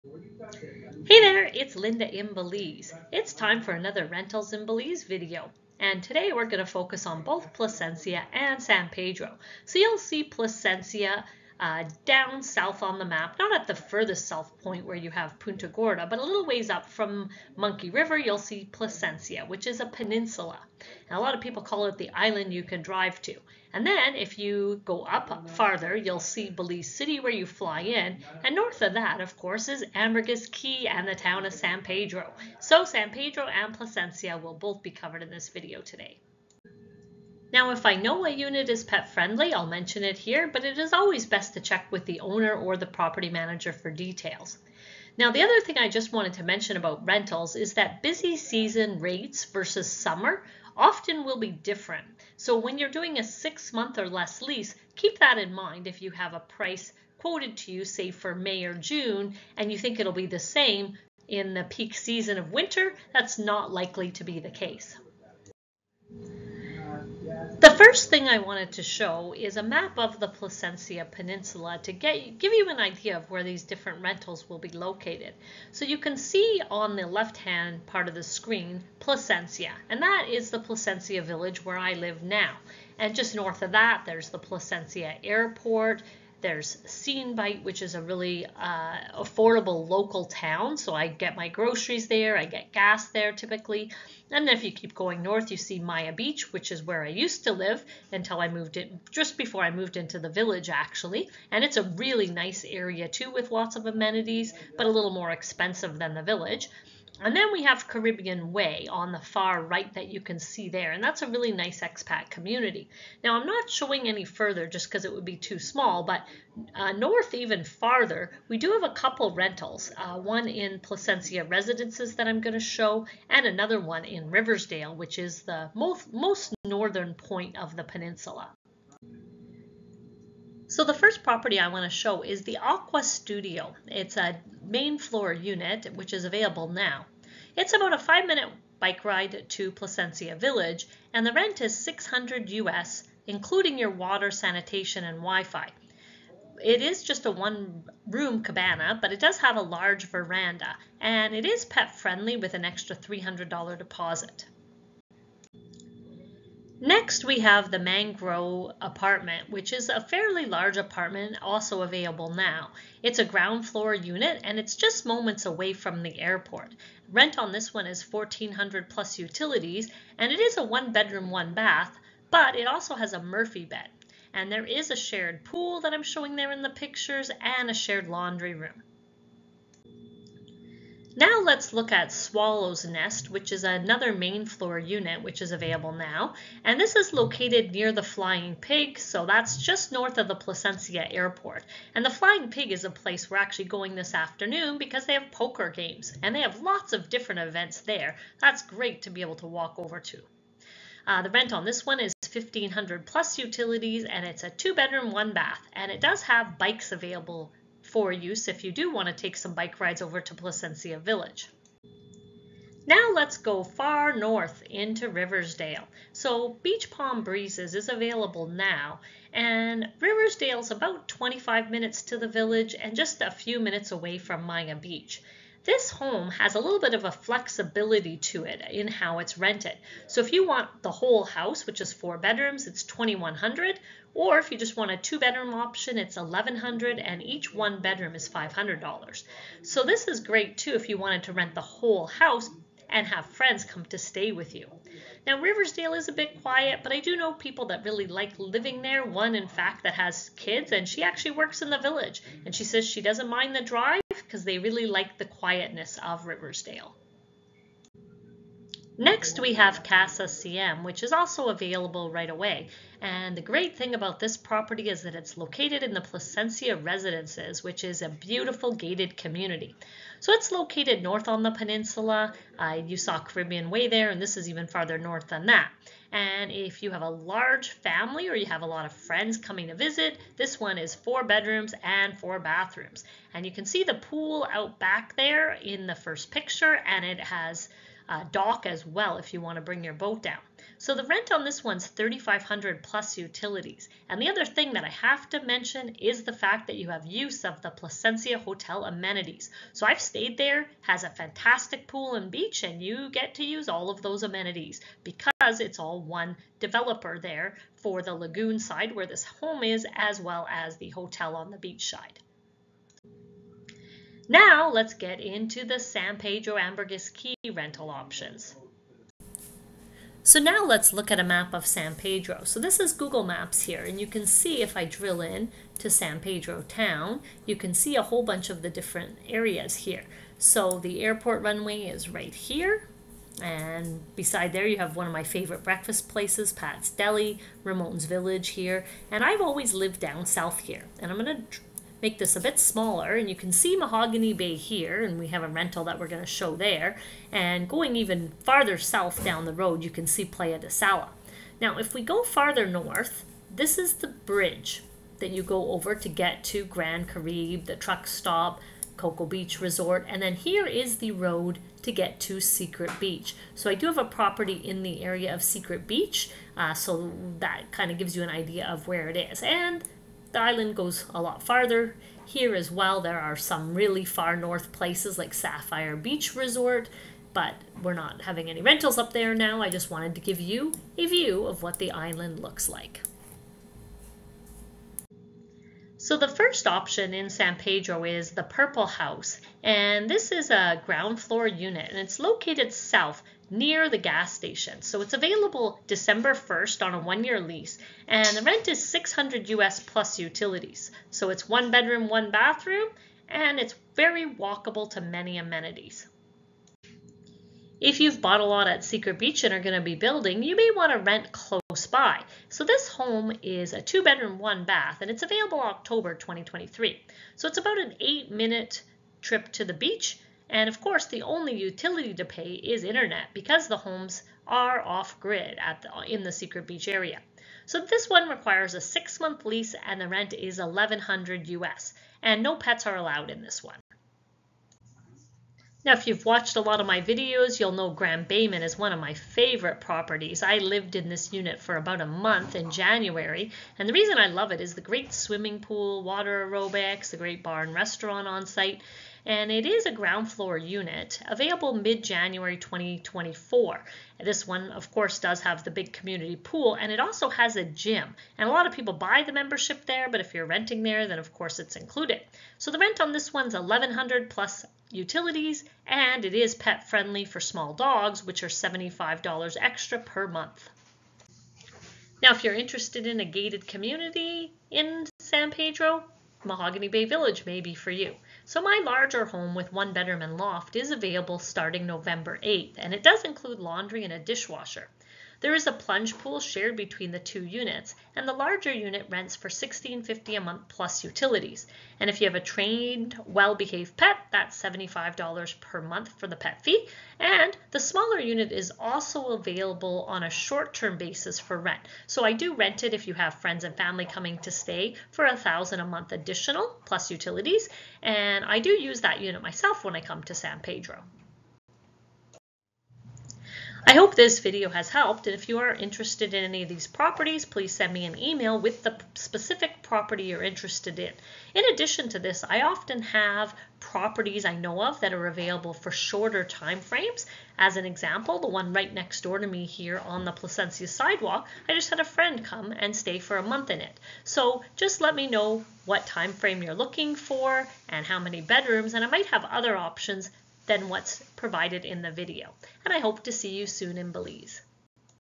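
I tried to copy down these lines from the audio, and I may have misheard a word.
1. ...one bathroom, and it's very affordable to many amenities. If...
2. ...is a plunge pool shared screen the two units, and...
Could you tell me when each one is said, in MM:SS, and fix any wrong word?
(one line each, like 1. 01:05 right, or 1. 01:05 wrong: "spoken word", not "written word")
1. 06:42 wrong: "walkable", not "affordable"
2. 08:05 wrong: "between", not "screen".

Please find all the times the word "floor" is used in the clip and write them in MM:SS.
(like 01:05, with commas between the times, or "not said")
02:14, 02:43, 03:04, 06:31, 07:30.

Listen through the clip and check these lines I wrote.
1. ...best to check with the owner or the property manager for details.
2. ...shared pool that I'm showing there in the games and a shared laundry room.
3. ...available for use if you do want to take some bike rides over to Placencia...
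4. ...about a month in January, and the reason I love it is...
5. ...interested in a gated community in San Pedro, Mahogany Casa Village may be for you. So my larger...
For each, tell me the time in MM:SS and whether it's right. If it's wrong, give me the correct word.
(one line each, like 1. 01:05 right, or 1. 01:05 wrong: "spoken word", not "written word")
1. 00:41 right
2. 02:54 wrong: "pictures", not "games"
3. 03:26 right
4. 07:21 right
5. 07:52 wrong: "Bay", not "Casa".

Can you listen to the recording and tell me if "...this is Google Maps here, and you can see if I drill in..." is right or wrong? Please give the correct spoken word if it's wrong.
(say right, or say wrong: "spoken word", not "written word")
right.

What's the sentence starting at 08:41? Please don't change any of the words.
In addition to this, I often have properties I know of that are available for shorter time frames.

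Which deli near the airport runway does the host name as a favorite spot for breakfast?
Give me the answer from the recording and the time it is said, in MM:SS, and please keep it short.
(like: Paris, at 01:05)
Pat's Deli, at 05:36.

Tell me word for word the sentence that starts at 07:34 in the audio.
This one, of course, does have the big community pool, and it also has a gym.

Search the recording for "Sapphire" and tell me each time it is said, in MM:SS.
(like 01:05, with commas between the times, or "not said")
06:15.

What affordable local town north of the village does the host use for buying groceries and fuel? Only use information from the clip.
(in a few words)
Seine Bight.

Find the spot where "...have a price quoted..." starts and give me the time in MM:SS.
00:56.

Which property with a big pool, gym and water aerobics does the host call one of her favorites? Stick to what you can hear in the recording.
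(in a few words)
Grand Baymen.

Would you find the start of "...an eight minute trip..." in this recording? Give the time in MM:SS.
06:57.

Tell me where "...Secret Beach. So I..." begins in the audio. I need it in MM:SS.
06:02.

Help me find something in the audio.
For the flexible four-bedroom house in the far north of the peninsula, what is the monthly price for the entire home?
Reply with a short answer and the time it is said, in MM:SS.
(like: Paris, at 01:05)
2100, at 03:52.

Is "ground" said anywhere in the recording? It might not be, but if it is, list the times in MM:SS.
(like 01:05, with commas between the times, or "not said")
02:43, 06:30, 07:29.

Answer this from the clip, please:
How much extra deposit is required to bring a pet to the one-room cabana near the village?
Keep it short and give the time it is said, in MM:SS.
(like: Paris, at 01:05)
$300, at 02:32.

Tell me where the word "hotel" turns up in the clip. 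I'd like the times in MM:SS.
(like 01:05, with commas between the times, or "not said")
04:58, 05:10.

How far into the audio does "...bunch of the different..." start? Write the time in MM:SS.
05:28.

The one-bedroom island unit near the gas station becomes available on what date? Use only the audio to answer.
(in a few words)
December 1st.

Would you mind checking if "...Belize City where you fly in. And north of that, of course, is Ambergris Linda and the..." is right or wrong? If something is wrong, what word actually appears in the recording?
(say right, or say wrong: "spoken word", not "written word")
wrong: "Caye", not "Linda".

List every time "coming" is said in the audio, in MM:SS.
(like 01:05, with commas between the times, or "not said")
04:39, 08:24.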